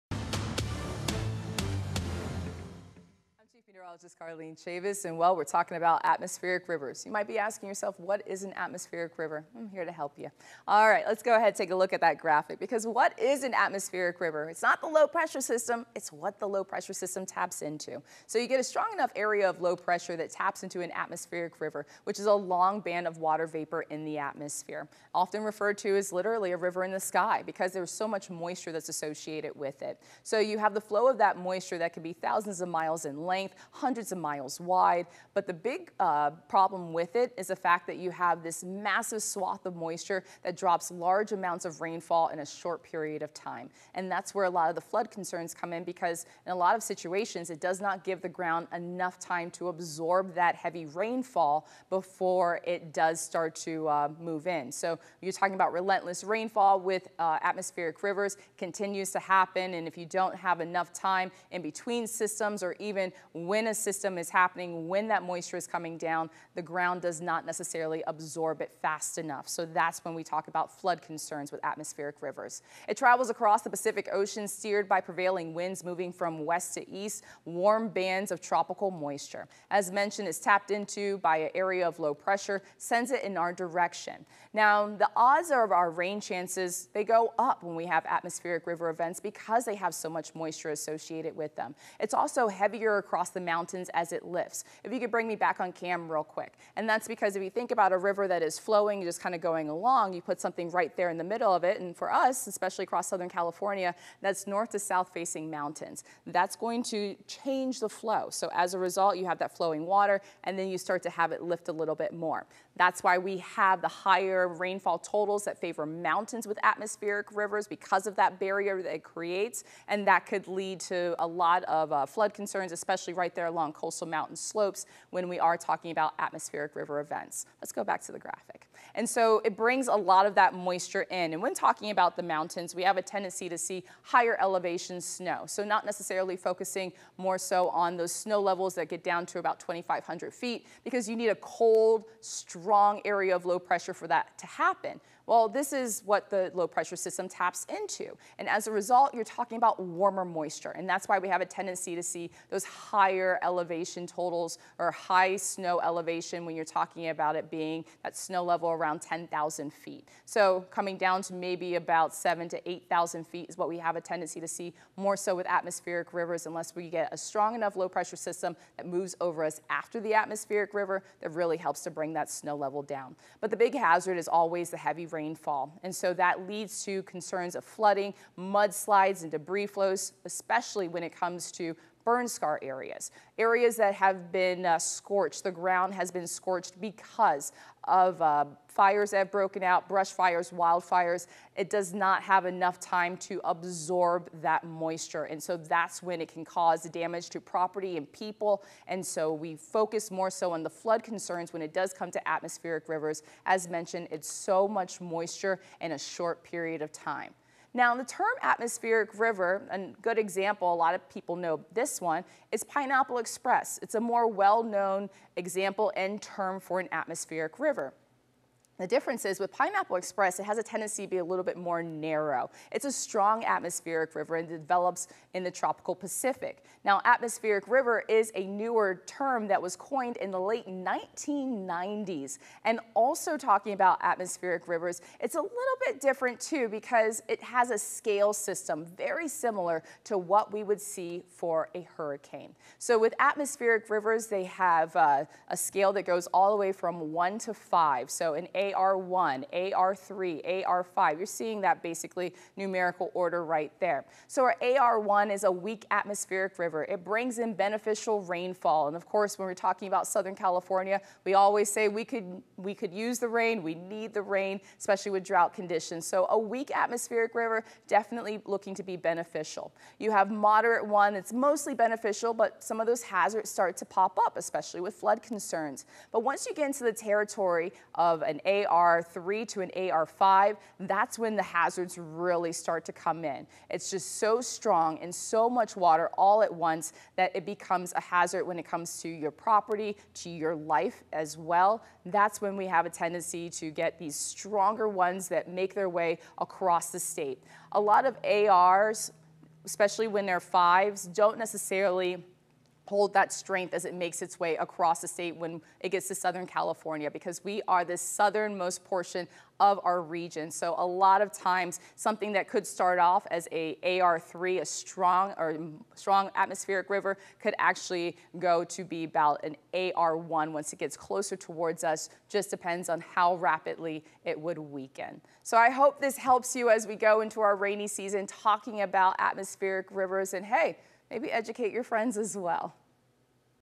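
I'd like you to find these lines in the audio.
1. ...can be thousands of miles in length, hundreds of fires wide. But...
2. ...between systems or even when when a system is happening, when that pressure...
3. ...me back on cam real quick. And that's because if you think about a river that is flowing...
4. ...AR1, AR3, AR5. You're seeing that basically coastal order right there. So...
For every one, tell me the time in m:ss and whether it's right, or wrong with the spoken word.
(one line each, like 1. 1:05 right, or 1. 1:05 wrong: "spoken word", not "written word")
1. 0:31 wrong: "miles", not "fires"
2. 1:01 wrong: "moisture", not "pressure"
3. 1:35 right
4. 4:08 wrong: "numerical", not "coastal".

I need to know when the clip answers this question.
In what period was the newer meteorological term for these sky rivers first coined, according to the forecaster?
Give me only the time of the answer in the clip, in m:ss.
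3:50.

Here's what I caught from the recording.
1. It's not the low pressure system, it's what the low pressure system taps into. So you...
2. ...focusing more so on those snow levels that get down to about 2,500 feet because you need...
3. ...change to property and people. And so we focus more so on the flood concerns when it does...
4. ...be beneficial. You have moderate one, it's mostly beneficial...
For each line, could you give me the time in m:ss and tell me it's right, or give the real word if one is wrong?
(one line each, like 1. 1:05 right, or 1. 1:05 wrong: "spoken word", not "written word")
1. 0:14 right
2. 2:16 right
3. 3:16 wrong: "damage", not "change"
4. 4:28 right.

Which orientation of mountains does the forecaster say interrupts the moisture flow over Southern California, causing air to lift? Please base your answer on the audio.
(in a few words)
north to south.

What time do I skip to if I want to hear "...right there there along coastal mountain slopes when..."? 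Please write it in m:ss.
2:03.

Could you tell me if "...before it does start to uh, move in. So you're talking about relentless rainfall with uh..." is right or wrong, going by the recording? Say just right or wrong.
right.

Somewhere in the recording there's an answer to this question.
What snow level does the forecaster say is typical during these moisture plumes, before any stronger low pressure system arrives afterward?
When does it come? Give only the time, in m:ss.
2:39.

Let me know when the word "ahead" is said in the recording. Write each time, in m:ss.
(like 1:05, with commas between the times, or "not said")
0:11.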